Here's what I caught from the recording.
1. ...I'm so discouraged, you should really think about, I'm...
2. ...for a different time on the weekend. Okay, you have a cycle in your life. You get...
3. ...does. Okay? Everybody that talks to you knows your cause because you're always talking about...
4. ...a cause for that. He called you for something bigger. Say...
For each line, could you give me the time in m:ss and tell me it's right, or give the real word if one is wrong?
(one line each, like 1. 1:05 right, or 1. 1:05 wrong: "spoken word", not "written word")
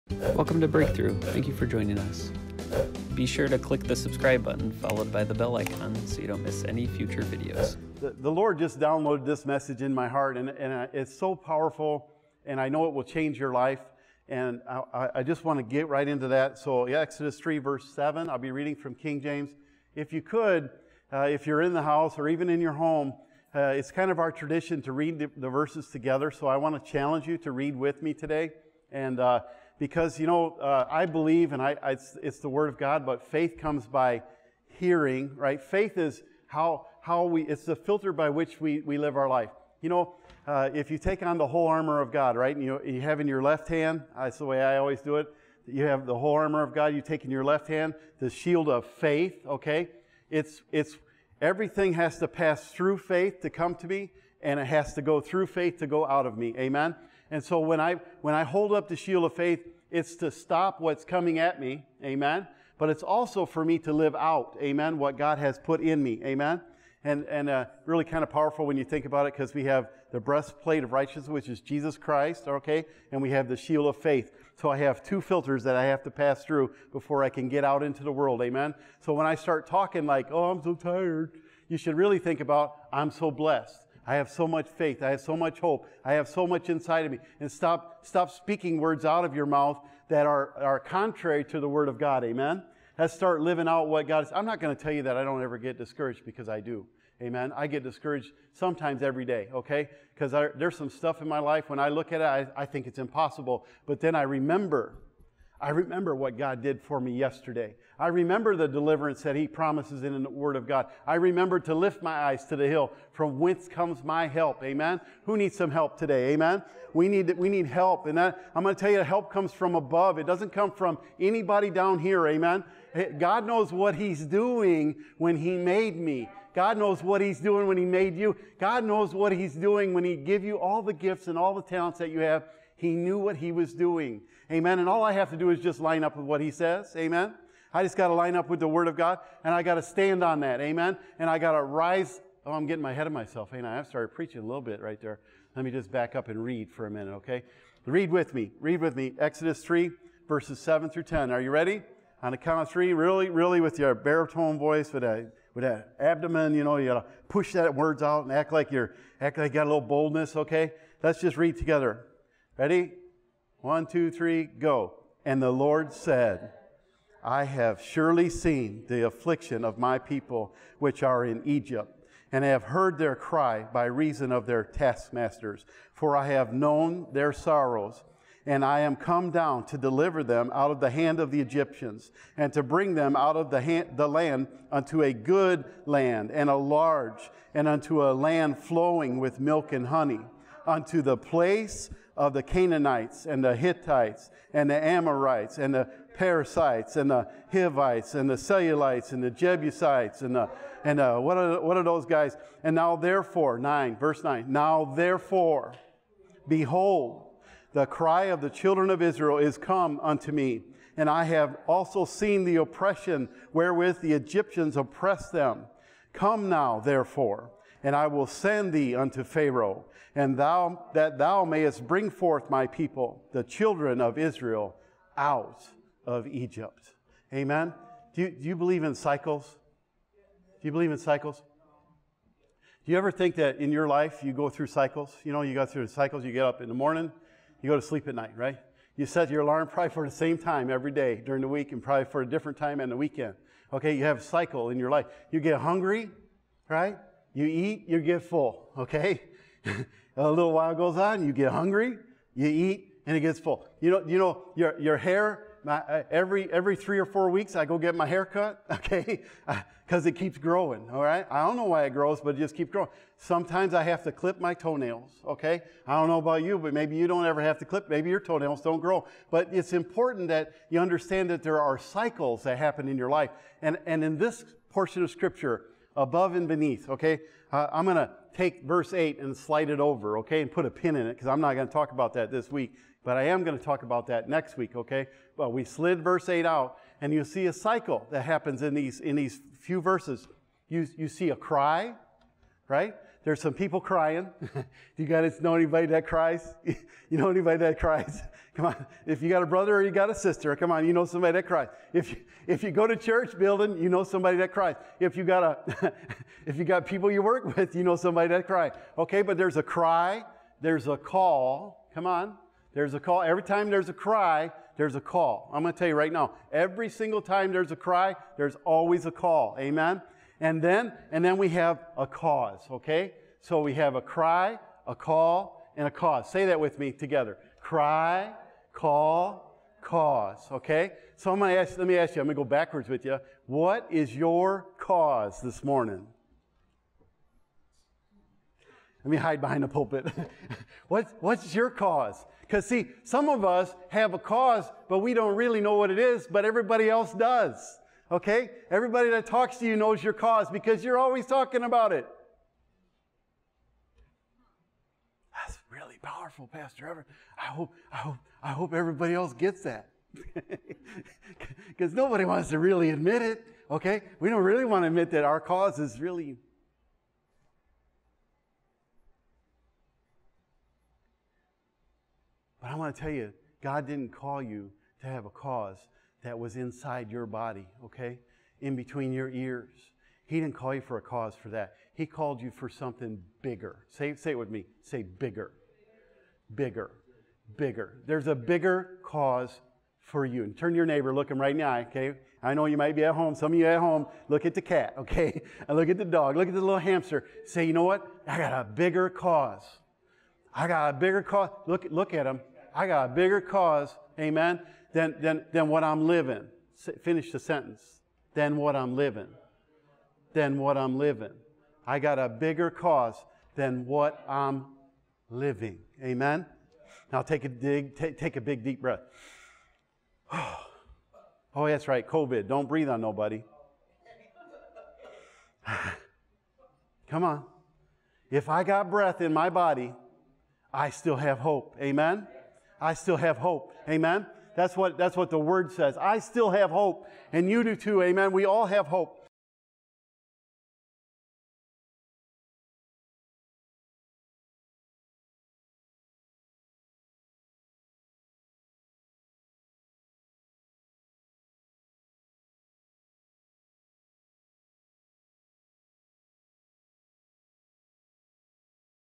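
1. 1:20 wrong: "tired", not "discouraged"
2. 4:02 right
3. 5:47 right
4. 6:20 right.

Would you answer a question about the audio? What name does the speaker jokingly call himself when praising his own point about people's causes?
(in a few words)
Pastor Everett.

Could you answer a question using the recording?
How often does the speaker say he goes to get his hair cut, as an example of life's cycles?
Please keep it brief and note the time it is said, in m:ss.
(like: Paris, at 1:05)
every 3 or 4 weeks, at 4:16.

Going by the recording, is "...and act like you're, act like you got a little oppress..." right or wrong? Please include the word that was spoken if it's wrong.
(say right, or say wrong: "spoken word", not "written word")
wrong: "boldness", not "oppress".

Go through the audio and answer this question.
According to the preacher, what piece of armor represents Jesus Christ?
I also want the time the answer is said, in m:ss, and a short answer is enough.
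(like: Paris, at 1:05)
breastplate of righteousness, at 1:10.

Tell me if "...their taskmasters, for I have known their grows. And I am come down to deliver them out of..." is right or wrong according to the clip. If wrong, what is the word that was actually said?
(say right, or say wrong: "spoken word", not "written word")
wrong: "sorrows", not "grows".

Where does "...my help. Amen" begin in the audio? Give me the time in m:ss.
1:54.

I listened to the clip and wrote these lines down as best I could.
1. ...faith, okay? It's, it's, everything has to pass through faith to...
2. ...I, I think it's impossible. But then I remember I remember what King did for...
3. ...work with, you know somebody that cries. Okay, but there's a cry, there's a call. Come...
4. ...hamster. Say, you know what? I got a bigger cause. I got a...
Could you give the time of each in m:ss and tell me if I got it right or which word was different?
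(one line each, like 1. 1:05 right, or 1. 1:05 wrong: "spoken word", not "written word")
1. 0:48 right
2. 1:42 wrong: "God", not "King"
3. 5:07 right
4. 6:36 right.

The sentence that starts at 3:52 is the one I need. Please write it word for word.
Do you ever think that in your life you go through cycles?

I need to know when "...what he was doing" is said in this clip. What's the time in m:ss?
2:13.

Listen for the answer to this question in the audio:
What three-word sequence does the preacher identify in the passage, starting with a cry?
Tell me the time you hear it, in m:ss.
5:27.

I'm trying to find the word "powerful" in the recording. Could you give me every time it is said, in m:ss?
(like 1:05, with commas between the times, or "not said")
0:11, 1:08, 5:56.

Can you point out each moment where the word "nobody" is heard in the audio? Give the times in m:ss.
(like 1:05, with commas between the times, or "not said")
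6:01, 7:03.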